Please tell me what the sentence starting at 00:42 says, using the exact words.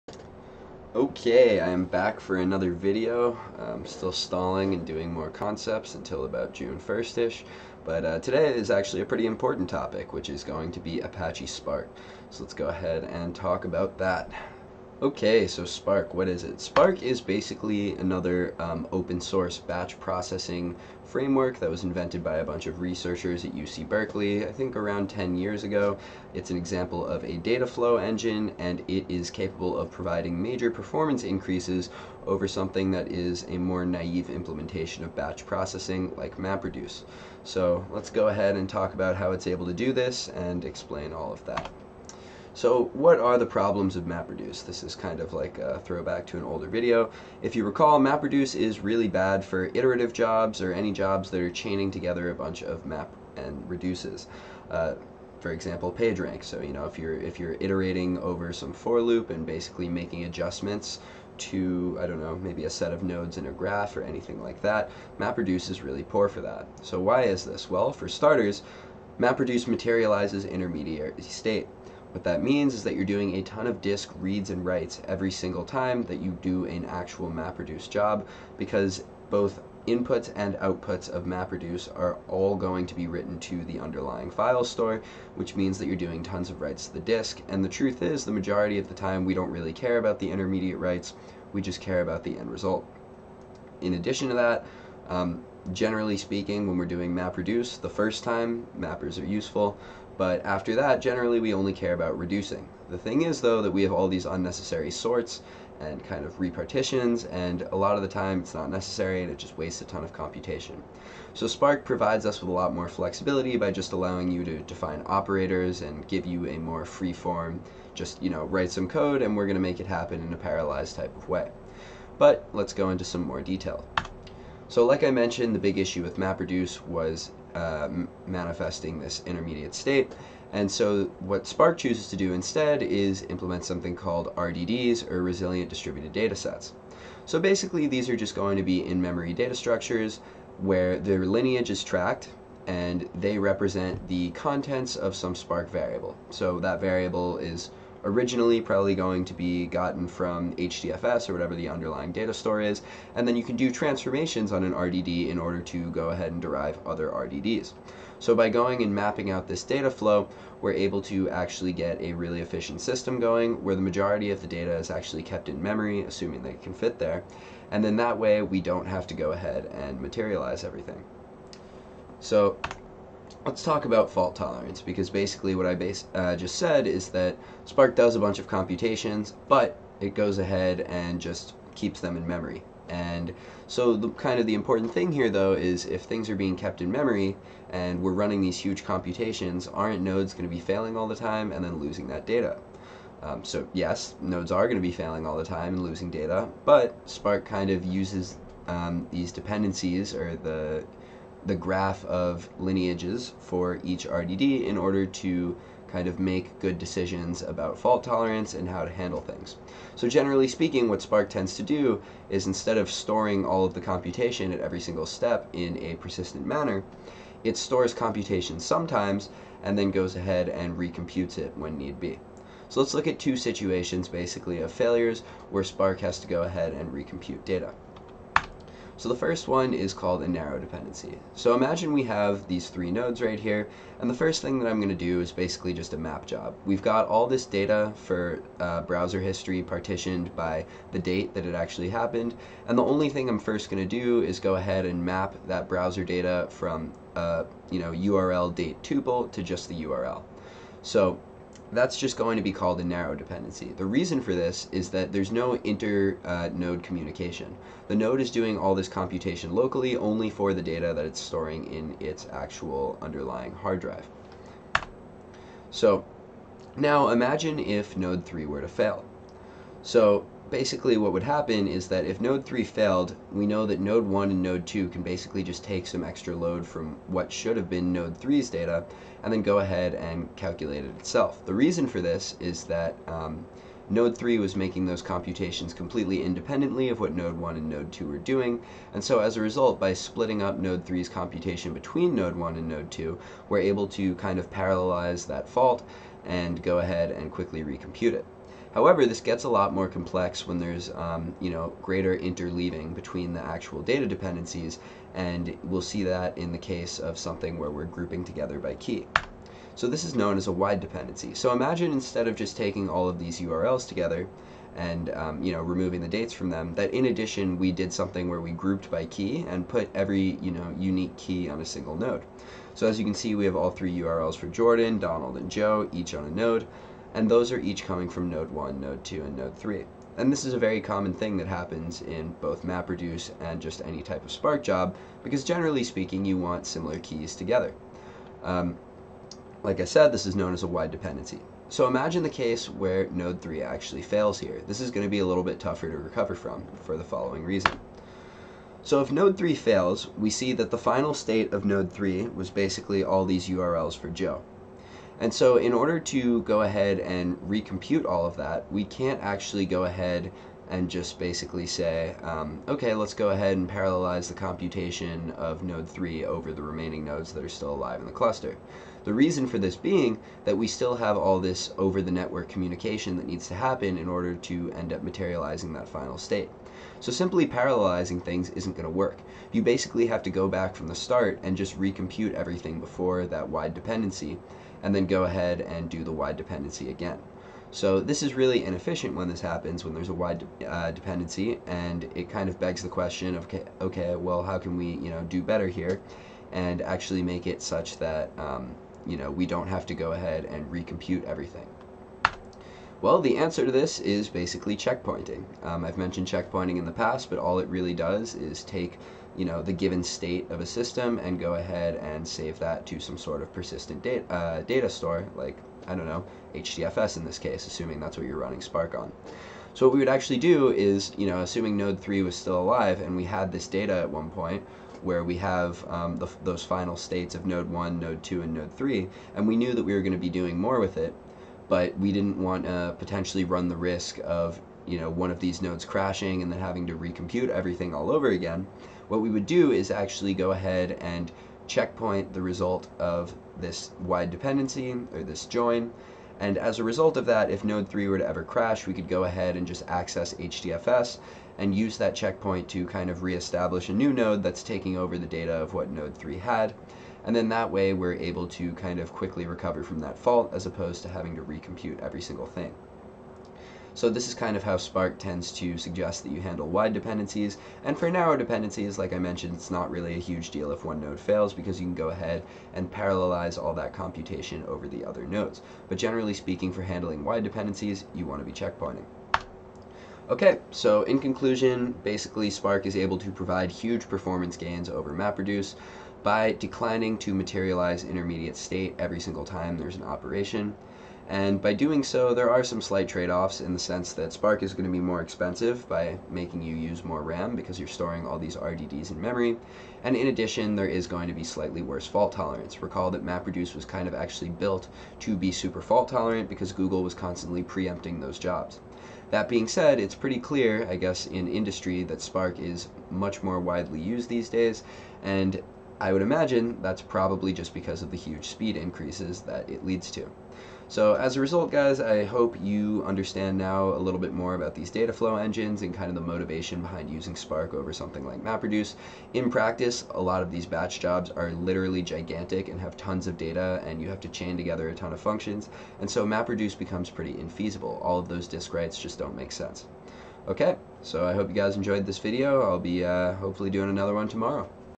So what are the problems of MapReduce?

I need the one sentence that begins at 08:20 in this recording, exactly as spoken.
And in addition, there is going to be slightly worse fault tolerance.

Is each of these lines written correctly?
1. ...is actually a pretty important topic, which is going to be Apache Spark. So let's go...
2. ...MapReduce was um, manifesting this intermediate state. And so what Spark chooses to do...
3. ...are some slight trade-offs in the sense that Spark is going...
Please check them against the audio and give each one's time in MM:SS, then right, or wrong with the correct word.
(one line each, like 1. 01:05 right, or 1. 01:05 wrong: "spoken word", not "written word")
1. 00:08 right
2. 02:06 right
3. 08:12 right.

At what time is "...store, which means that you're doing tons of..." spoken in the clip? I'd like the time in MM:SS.
01:24.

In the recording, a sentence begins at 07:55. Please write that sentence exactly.
But generally speaking, for handling wide dependencies, you want to be checkpointing.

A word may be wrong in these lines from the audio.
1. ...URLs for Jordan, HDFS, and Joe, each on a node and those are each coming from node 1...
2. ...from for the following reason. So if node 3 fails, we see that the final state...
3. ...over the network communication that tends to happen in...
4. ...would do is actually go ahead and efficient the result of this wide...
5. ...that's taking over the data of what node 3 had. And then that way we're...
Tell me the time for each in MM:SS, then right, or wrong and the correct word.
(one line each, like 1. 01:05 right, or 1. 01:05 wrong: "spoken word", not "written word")
1. 05:23 wrong: "Donald", not "HDFS"
2. 05:46 right
3. 06:11 wrong: "needs", not "tends"
4. 07:19 wrong: "checkpoint", not "efficient"
5. 07:34 right.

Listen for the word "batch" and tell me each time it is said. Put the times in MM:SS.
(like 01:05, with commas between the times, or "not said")
00:19, 00:35, 08:50.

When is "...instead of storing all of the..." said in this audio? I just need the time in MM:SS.
03:32.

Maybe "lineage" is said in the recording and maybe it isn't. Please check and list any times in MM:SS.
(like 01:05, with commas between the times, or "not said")
02:21, 03:22.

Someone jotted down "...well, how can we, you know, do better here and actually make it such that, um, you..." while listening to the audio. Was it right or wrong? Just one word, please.
right.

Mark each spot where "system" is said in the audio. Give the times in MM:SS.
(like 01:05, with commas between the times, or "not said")
02:42, 06:50.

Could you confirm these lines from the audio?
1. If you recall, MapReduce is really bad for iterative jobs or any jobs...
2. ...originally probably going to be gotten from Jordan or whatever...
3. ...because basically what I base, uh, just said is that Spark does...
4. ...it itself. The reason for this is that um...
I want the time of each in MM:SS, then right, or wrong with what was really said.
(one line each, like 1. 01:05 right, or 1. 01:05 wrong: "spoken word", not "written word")
1. 00:47 right
2. 02:28 wrong: "HDFS", not "Jordan"
3. 02:54 right
4. 04:40 right.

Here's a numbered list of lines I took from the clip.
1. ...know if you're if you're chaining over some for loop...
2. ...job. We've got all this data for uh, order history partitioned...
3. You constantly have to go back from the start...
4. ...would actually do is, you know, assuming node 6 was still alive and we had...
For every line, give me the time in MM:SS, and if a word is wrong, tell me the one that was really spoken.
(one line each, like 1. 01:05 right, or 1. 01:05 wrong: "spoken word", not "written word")
1. 00:56 wrong: "iterating", not "chaining"
2. 03:56 wrong: "browser", not "order"
3. 06:19 wrong: "basically", not "constantly"
4. 06:59 wrong: "3", not "6".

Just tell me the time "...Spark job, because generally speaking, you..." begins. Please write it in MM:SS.
05:34.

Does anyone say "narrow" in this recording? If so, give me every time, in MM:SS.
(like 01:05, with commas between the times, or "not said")
03:50, 04:12, 07:48.